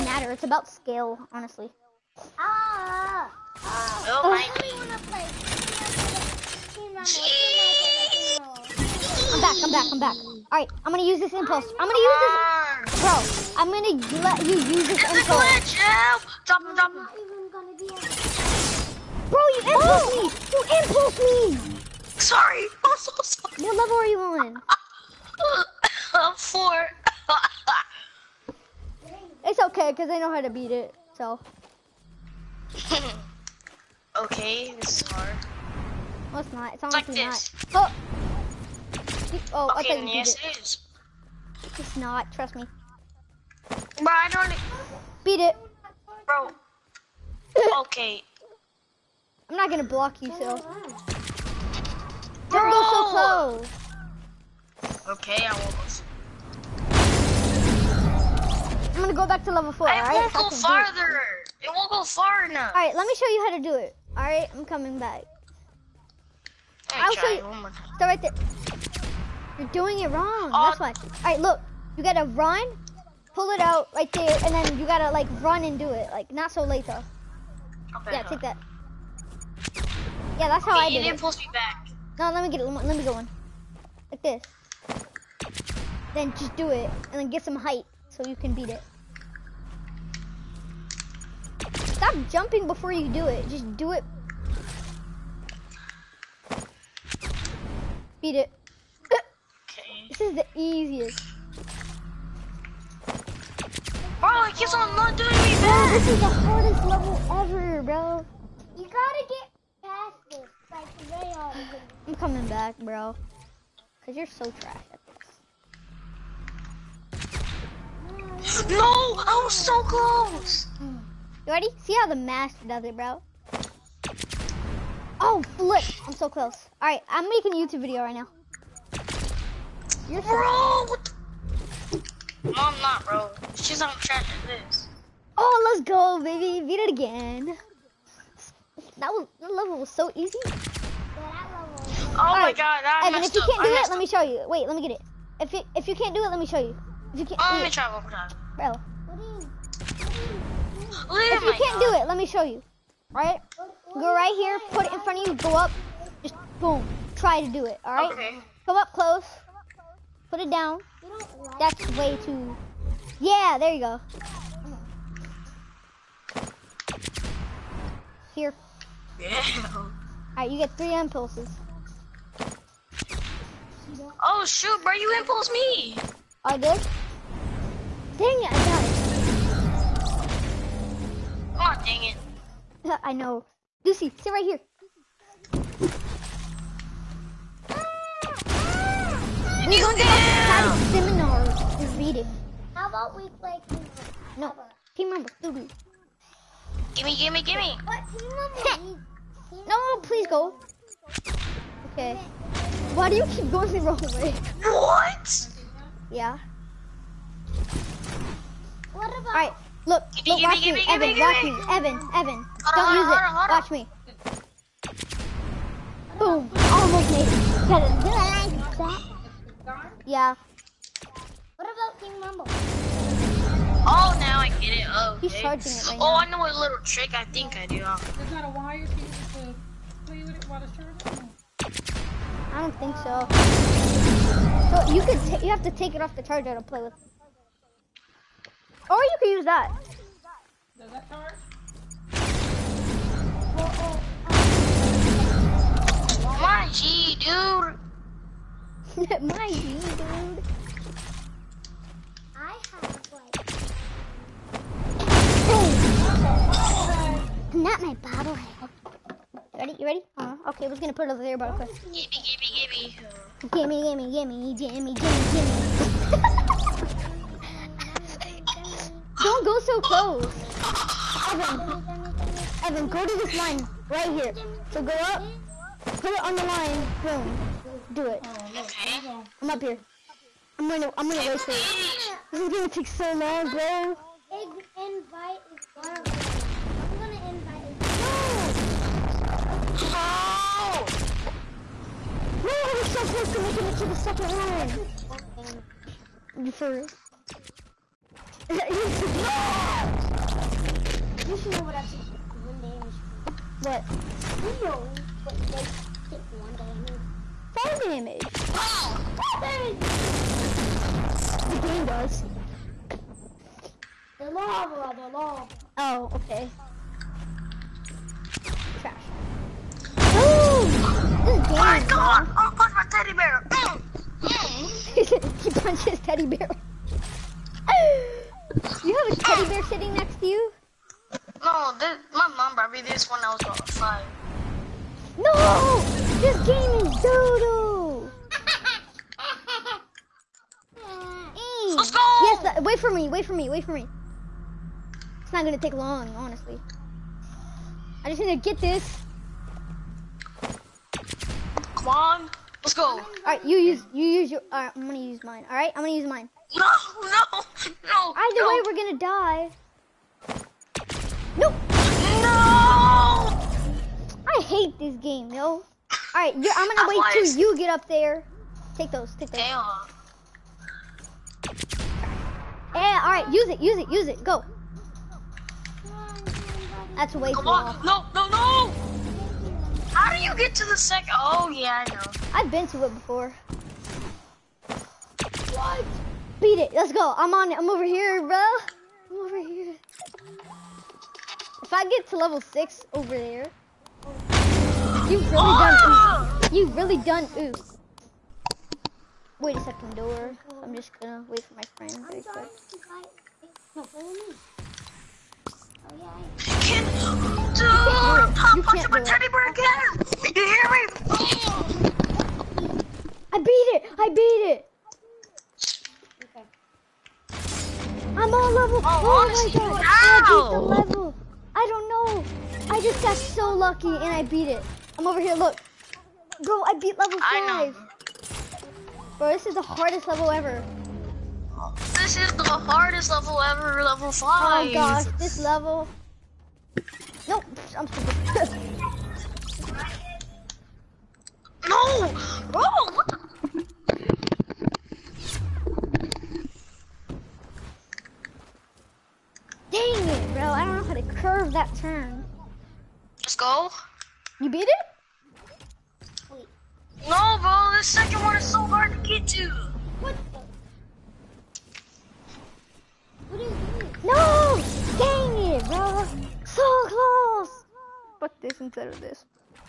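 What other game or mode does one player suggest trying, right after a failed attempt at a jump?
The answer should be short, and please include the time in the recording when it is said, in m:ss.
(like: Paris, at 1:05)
King Rumble, at 3:41.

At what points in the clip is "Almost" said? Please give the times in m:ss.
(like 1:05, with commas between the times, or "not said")
3:36.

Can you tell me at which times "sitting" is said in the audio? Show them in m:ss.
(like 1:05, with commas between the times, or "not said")
5:29.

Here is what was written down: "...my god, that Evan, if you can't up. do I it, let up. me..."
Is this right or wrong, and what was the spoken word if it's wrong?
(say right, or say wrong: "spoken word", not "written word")
right.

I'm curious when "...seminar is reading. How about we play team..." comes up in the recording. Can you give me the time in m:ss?
3:10.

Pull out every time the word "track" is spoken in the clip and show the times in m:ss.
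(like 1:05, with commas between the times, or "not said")
2:14.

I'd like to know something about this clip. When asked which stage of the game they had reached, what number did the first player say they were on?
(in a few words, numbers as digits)
4.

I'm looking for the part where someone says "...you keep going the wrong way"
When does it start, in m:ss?
3:23.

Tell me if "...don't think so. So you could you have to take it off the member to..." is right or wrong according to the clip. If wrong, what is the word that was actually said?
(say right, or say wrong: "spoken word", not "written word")
wrong: "charger", not "member".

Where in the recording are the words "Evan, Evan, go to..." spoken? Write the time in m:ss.
4:31.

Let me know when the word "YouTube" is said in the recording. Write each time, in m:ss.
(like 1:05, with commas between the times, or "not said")
2:07.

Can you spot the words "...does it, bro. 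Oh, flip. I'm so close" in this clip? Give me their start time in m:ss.
2:02.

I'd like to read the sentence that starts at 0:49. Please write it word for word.
I'm not gonna block you, so.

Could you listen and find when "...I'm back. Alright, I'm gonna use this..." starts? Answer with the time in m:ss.
0:09.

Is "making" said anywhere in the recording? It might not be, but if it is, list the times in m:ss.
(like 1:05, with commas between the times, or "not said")
2:07, 4:53.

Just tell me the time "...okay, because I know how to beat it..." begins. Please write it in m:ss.
0:29.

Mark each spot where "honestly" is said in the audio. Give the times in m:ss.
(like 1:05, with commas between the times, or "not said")
0:01, 0:36, 5:46.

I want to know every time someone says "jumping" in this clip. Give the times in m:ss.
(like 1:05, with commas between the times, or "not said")
1:32.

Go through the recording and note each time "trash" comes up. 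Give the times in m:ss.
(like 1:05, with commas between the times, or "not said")
1:54, 5:18.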